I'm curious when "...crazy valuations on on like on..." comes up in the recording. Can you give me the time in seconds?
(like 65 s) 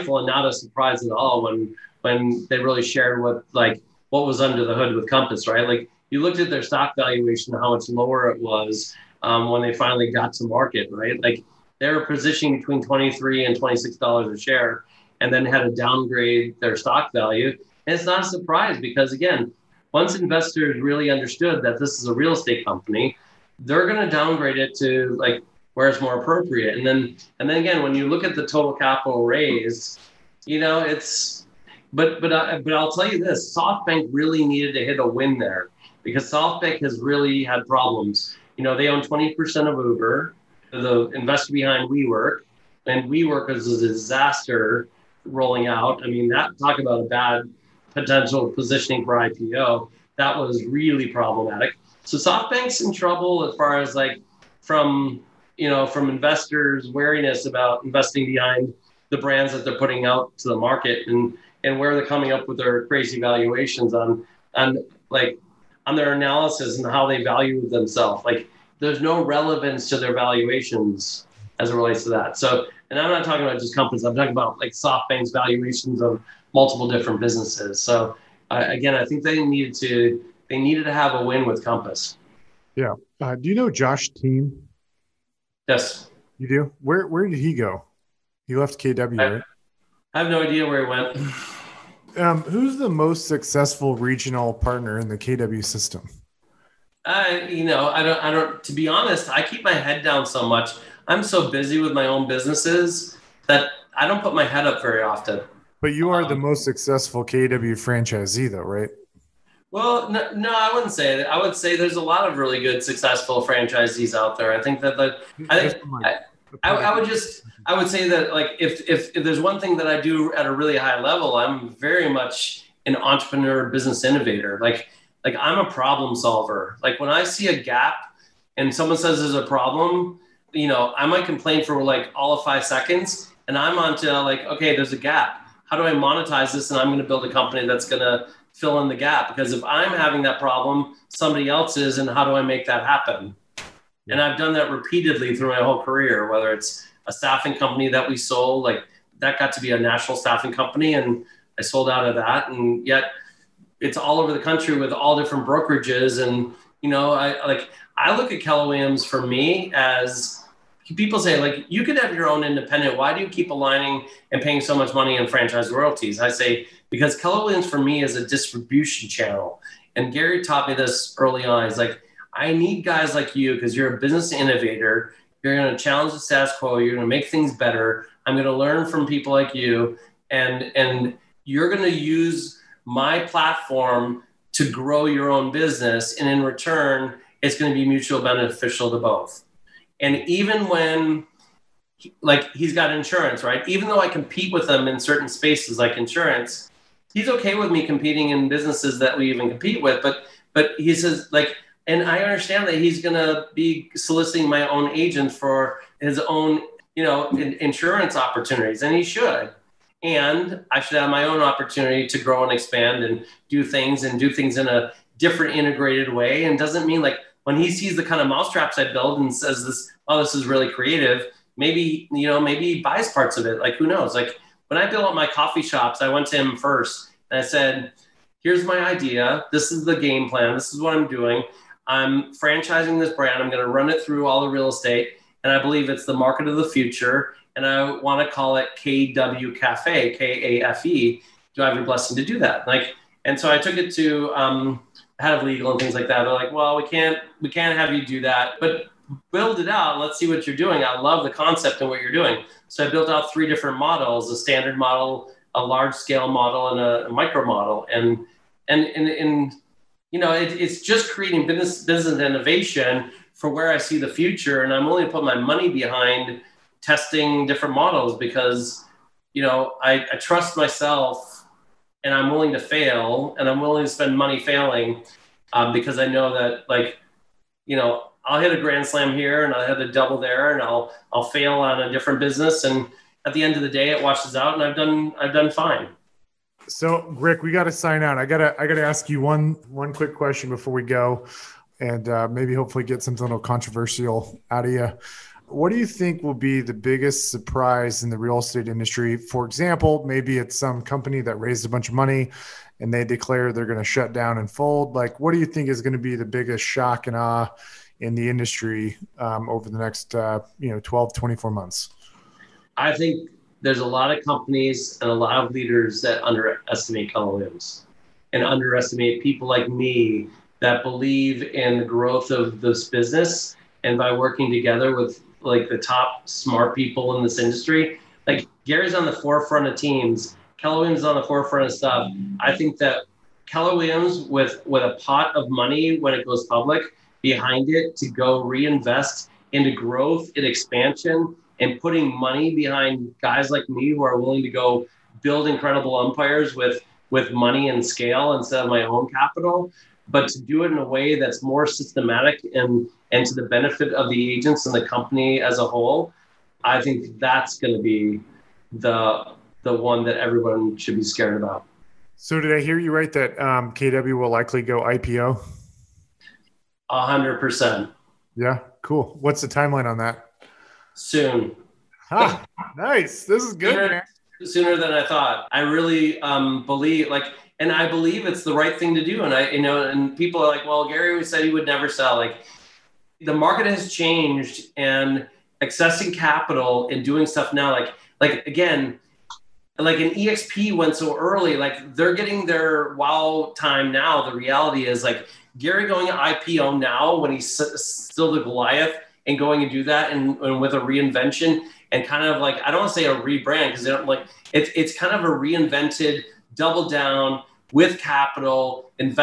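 62 s.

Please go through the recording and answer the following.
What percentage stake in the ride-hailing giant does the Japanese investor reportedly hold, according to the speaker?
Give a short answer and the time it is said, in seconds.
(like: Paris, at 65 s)
20%, at 39 s.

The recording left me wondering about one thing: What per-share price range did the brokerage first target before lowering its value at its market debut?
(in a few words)
$23 to $26.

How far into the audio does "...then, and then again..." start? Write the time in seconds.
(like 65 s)
26 s.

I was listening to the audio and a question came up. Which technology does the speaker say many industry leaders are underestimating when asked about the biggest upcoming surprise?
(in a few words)
LLMs.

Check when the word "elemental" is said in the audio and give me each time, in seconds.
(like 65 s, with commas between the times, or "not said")
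not said.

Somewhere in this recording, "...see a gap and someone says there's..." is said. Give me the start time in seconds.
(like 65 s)
127 s.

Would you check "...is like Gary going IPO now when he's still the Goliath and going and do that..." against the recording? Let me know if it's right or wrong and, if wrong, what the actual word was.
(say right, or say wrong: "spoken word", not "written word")
right.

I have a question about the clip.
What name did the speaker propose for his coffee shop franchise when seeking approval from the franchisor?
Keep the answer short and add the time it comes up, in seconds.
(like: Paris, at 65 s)
KW Cafe, at 238 s.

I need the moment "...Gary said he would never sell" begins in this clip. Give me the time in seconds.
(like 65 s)
380 s.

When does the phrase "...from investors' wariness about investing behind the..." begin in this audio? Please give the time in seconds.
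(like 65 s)
55 s.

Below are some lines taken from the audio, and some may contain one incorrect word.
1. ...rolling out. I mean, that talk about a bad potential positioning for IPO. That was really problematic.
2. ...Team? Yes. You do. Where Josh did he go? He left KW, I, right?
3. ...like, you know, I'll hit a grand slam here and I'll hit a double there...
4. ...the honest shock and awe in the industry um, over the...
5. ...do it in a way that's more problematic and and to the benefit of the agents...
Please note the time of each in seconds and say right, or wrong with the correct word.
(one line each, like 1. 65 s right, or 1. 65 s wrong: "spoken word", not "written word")
1. 45 s right
2. 84 s wrong: "Where", not "Josh"
3. 276 s right
4. 306 s wrong: "biggest", not "honest"
5. 350 s wrong: "systematic", not "problematic".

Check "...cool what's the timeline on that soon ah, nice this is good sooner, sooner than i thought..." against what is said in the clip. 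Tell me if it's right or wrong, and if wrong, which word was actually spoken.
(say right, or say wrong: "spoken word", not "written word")
right.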